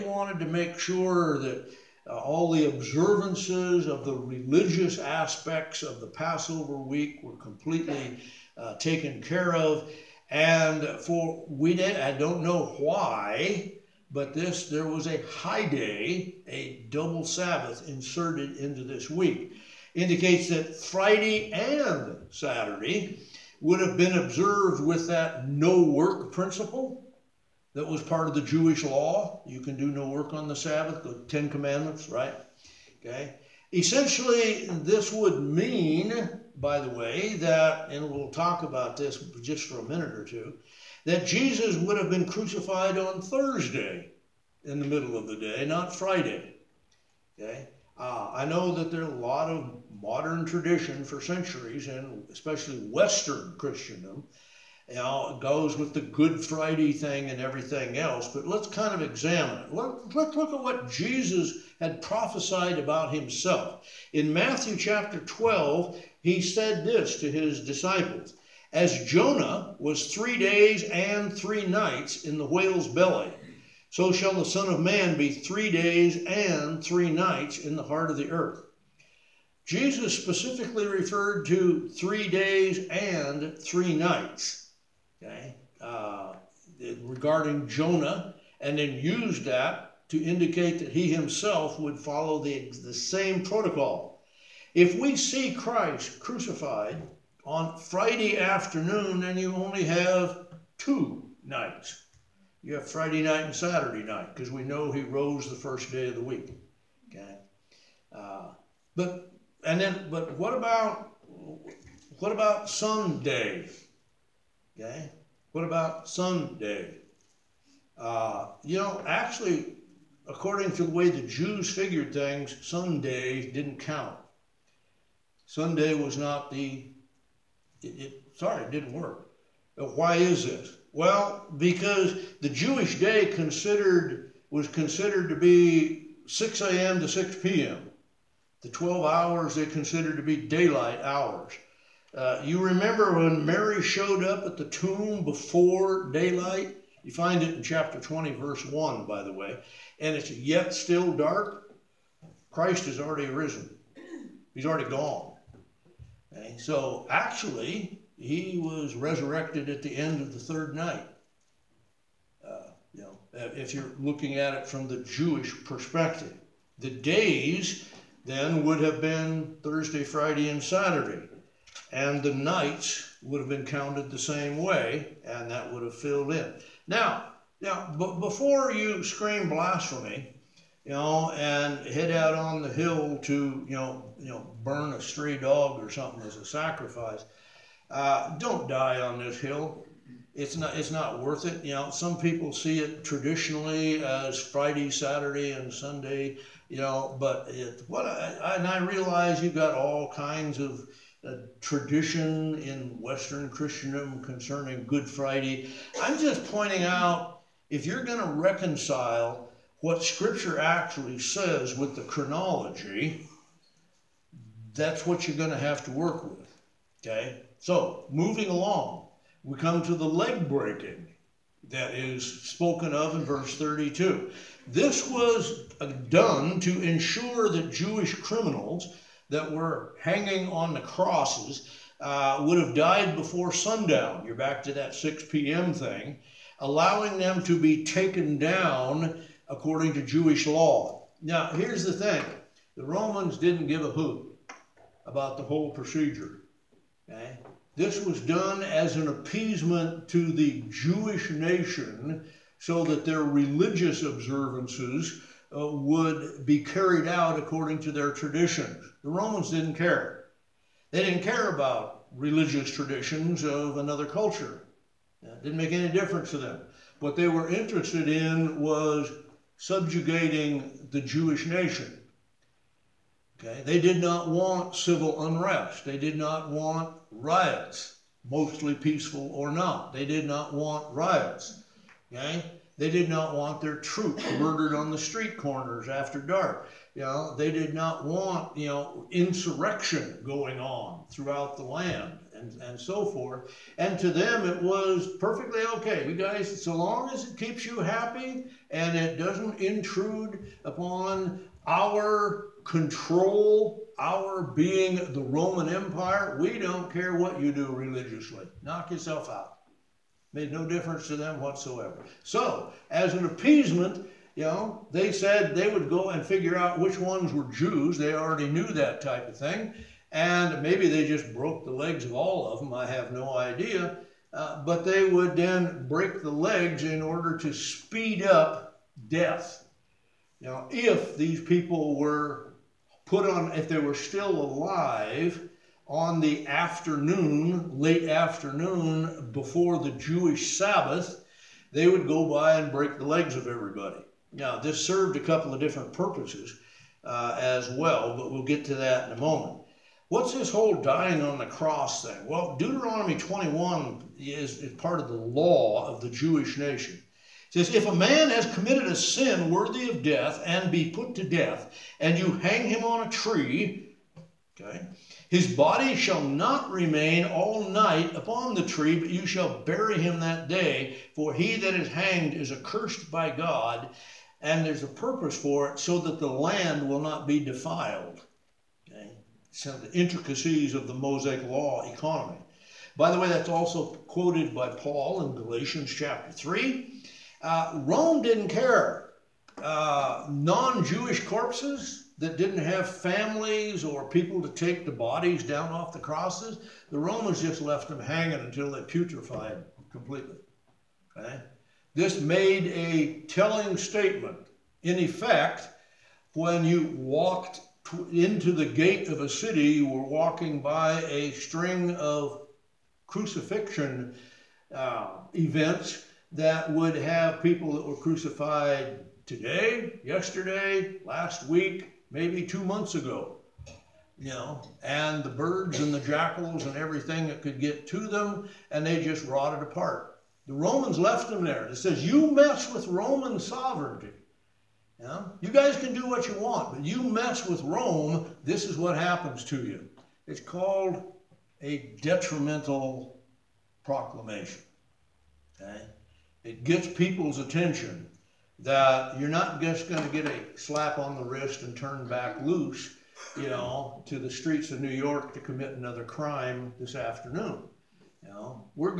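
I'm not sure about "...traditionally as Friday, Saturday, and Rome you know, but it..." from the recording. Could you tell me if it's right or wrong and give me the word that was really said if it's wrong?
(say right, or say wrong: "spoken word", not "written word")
wrong: "Sunday", not "Rome".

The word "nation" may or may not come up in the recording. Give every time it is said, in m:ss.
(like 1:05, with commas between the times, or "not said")
4:11, 4:31, 5:56.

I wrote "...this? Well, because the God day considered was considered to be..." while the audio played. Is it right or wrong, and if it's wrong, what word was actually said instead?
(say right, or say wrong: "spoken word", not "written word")
wrong: "Jewish", not "God".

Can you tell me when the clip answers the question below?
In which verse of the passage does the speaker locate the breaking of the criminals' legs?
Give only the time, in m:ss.
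3:43.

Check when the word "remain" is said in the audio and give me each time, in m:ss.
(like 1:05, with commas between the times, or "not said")
6:06.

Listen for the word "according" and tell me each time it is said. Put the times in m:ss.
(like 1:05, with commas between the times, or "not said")
2:00, 3:59, 4:17.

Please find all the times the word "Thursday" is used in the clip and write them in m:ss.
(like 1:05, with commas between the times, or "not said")
0:43, 2:49.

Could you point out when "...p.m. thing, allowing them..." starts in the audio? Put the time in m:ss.
3:55.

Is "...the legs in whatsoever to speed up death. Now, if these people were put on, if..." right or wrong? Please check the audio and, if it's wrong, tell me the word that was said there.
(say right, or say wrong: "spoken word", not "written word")
wrong: "order", not "whatsoever".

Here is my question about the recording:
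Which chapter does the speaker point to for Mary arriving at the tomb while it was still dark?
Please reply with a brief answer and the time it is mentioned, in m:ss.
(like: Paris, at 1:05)
Chapter 20, at 2:27.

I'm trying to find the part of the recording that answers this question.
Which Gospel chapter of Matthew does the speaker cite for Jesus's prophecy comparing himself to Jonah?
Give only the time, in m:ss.
1:04.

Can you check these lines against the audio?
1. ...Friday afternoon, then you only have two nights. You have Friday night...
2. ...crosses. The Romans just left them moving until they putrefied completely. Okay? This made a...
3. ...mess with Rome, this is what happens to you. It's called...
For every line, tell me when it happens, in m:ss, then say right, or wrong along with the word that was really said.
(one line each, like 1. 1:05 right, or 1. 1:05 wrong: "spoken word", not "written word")
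1. 1:37 right
2. 6:35 wrong: "hanging", not "moving"
3. 7:17 right.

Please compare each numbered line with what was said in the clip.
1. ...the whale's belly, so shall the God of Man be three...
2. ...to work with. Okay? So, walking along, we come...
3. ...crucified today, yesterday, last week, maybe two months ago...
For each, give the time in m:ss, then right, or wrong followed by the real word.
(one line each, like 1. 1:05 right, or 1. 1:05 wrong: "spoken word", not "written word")
1. 1:12 wrong: "Son", not "God"
2. 3:35 wrong: "moving", not "walking"
3. 6:57 right.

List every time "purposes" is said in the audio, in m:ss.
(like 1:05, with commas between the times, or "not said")
5:45, 6:14.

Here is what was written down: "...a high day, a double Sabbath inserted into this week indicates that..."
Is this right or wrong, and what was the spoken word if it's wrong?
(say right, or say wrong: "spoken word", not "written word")
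right.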